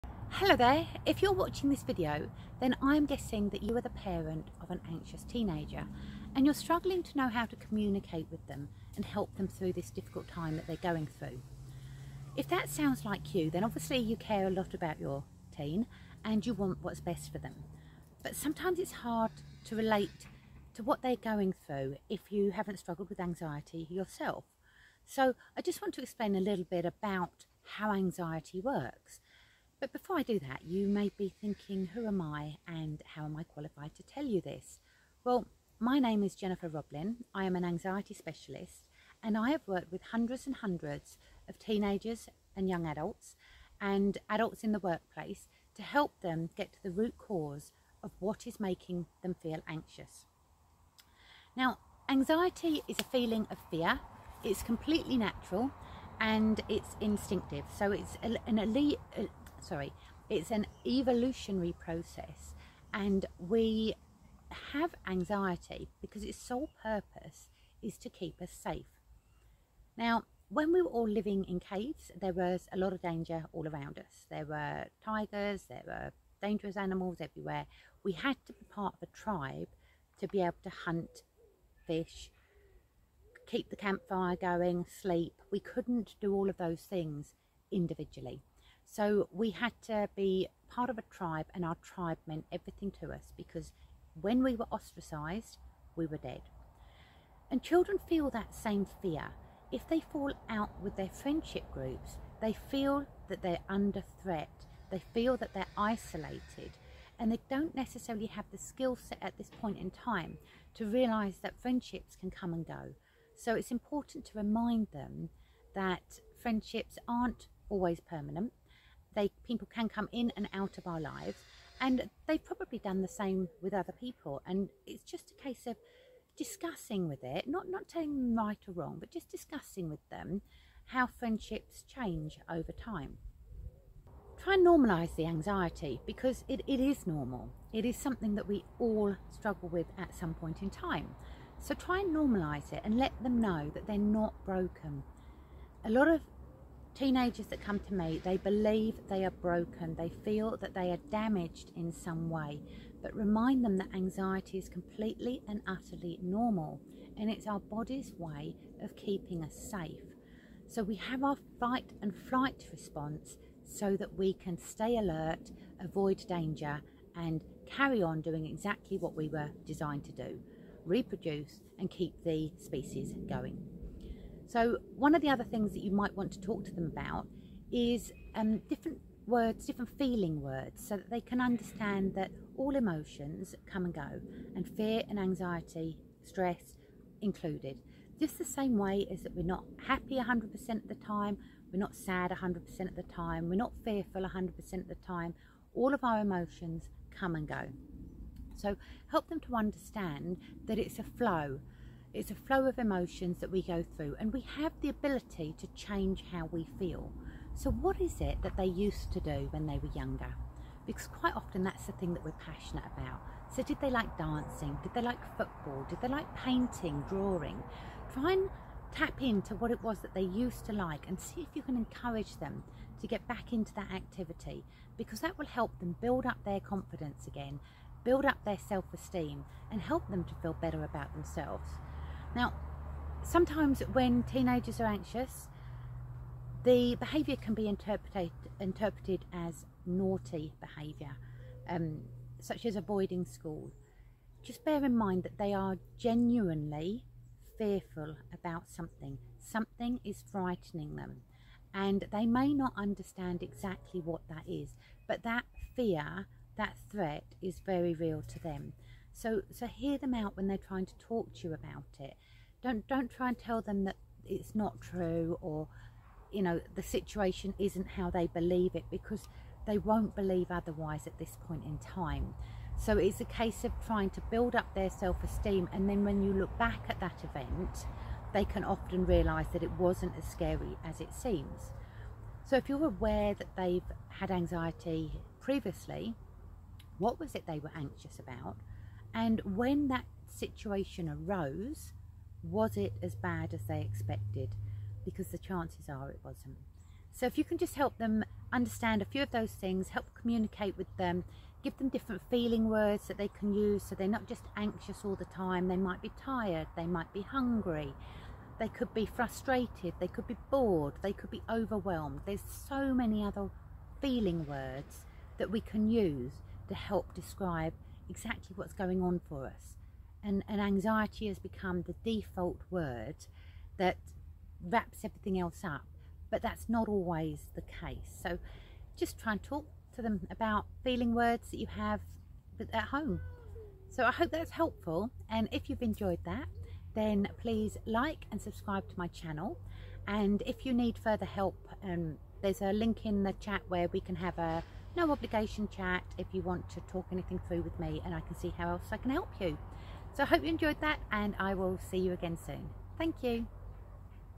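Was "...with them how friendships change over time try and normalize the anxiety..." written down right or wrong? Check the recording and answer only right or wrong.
right.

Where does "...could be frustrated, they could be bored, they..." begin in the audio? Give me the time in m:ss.
5:08.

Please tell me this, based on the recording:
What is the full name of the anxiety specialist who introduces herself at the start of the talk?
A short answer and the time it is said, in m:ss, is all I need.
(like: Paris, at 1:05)
Jennifer Roblin, at 0:36.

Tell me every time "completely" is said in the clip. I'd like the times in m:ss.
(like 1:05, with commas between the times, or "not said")
0:54, 2:34.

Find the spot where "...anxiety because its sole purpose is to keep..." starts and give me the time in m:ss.
1:05.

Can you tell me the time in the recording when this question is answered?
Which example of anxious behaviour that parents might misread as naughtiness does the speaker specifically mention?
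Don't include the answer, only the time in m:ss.
4:02.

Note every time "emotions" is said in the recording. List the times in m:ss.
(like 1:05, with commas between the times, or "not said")
3:02, 3:16, 3:22.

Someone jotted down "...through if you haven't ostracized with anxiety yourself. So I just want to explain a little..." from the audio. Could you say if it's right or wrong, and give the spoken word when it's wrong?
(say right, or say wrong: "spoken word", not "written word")
wrong: "struggled", not "ostracized".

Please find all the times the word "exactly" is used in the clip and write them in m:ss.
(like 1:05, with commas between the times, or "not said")
2:48, 4:13, 5:18.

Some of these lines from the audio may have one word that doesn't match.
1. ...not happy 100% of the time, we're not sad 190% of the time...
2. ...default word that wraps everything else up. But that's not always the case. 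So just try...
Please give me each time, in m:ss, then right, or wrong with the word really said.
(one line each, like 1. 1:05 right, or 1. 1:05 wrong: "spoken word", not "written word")
1. 3:09 wrong: "100", not "190"
2. 5:22 right.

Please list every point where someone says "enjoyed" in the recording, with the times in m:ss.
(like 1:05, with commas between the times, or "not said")
5:35, 5:50.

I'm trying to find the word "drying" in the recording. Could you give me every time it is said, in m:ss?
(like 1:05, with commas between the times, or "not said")
not said.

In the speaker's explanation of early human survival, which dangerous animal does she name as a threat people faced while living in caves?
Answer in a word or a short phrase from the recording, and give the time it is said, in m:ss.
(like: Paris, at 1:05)
Tigers, at 1:15.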